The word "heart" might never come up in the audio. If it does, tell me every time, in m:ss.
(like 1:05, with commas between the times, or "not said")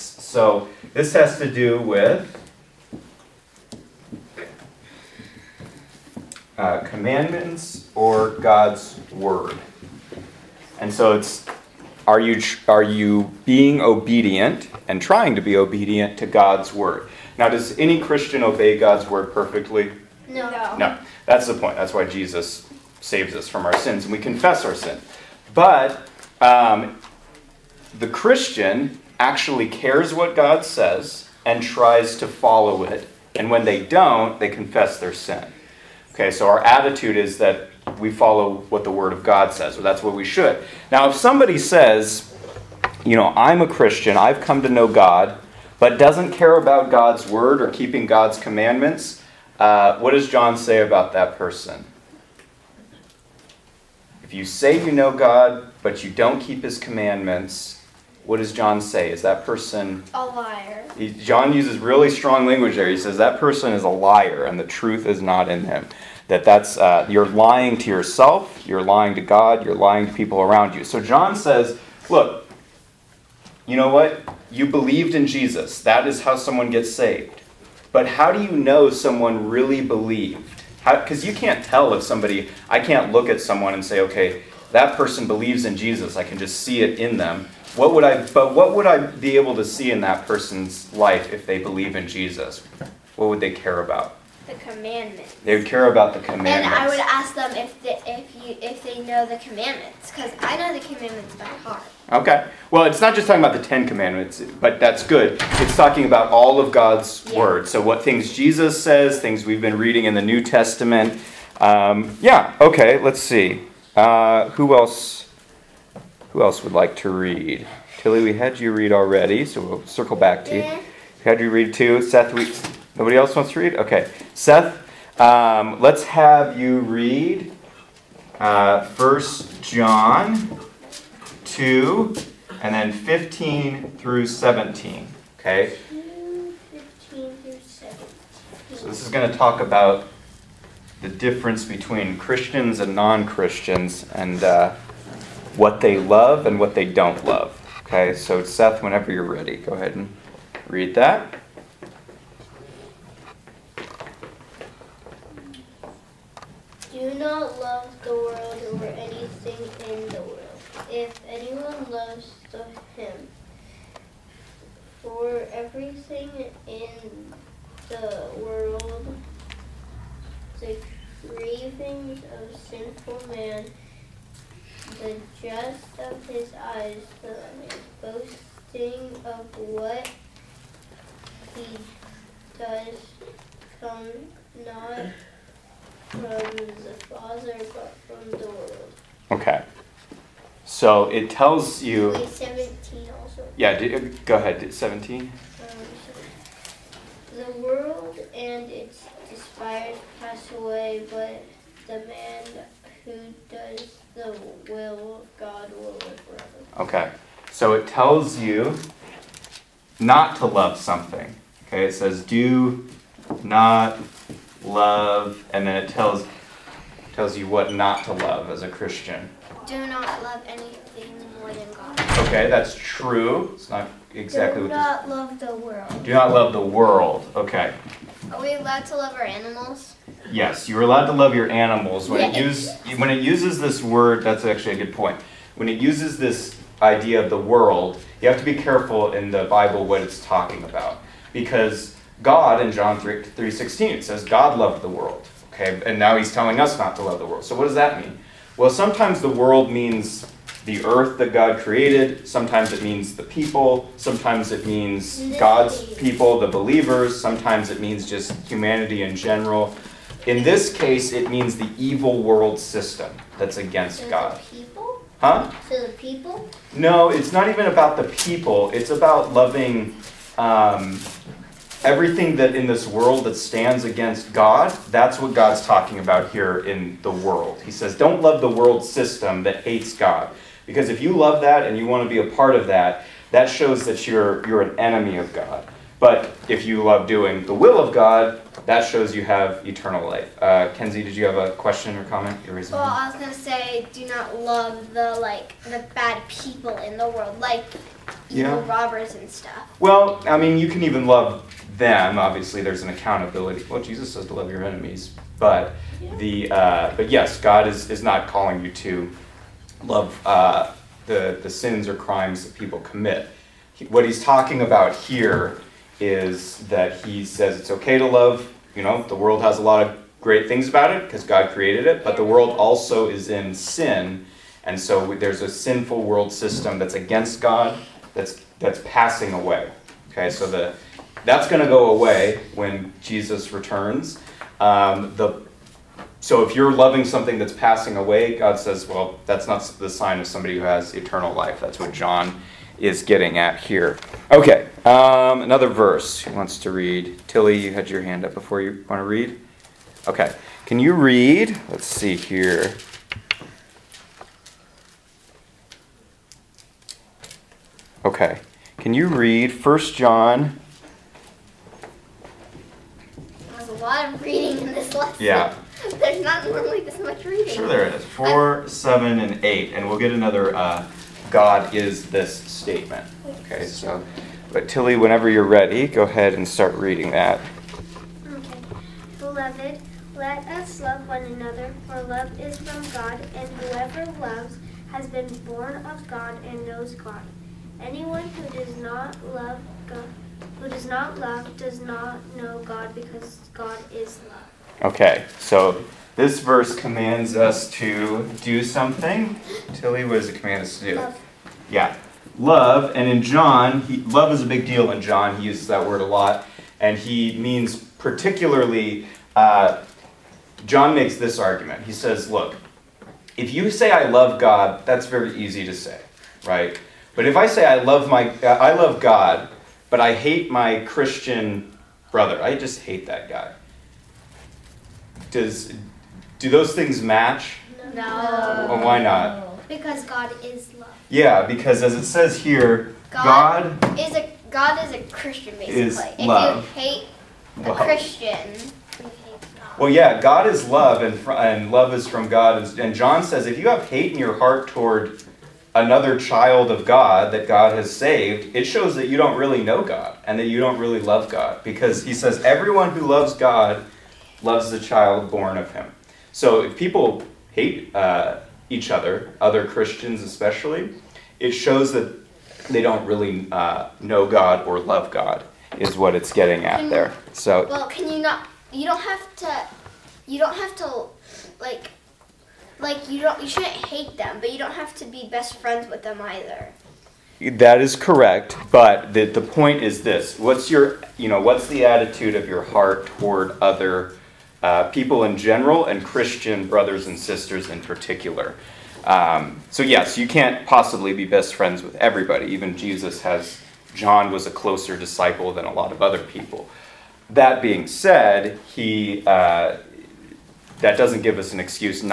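1:41, 7:24, 8:02.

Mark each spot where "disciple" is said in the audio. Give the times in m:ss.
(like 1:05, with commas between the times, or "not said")
8:14.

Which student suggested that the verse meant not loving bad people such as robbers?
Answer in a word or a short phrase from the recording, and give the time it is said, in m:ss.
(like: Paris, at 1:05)
Kenzie, at 4:50.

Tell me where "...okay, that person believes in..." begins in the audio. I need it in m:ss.
1:24.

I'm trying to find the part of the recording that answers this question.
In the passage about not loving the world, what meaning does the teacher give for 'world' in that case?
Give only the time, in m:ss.
4:21.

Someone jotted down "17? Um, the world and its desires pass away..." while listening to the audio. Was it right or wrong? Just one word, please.
right.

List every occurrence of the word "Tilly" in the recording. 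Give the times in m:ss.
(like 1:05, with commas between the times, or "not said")
1:57, 5:47, 6:14, 6:39.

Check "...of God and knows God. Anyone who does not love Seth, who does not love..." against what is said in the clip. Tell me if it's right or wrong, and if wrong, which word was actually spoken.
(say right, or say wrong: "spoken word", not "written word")
wrong: "God", not "Seth".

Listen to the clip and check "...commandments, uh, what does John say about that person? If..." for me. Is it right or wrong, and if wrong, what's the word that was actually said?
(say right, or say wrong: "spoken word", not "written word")
right.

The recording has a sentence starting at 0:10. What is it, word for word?
And so it's are you, are you being obedient and trying to be obedient to God's word?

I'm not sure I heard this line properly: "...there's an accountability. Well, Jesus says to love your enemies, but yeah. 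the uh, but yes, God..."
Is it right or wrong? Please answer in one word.
right.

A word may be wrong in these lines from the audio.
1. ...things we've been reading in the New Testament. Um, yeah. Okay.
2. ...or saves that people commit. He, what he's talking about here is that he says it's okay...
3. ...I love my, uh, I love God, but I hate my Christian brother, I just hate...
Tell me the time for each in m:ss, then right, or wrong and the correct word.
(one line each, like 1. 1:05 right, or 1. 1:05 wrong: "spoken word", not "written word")
1. 1:49 right
2. 5:11 wrong: "crimes", not "saves"
3. 6:57 right.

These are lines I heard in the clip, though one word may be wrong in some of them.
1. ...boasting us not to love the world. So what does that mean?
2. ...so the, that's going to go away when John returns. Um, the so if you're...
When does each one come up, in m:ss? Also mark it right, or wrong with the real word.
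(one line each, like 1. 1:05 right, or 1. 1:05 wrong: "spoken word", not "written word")
1. 4:06 wrong: "telling", not "boasting"
2. 5:30 wrong: "Jesus", not "John".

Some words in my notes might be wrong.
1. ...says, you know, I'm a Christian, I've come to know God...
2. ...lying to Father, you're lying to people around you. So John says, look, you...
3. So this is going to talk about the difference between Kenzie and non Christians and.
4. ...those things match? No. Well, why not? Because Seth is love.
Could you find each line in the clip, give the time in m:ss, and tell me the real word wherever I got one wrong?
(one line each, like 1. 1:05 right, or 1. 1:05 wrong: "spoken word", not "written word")
1. 0:41 right
2. 1:08 wrong: "God", not "Father"
3. 2:18 wrong: "Christians", not "Kenzie"
4. 7:06 wrong: "God", not "Seth".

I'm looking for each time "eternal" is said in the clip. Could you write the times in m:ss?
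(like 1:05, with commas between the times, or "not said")
4:49, 5:40.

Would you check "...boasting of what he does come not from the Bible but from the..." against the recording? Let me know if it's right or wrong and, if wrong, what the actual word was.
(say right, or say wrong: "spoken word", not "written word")
wrong: "Father", not "Bible".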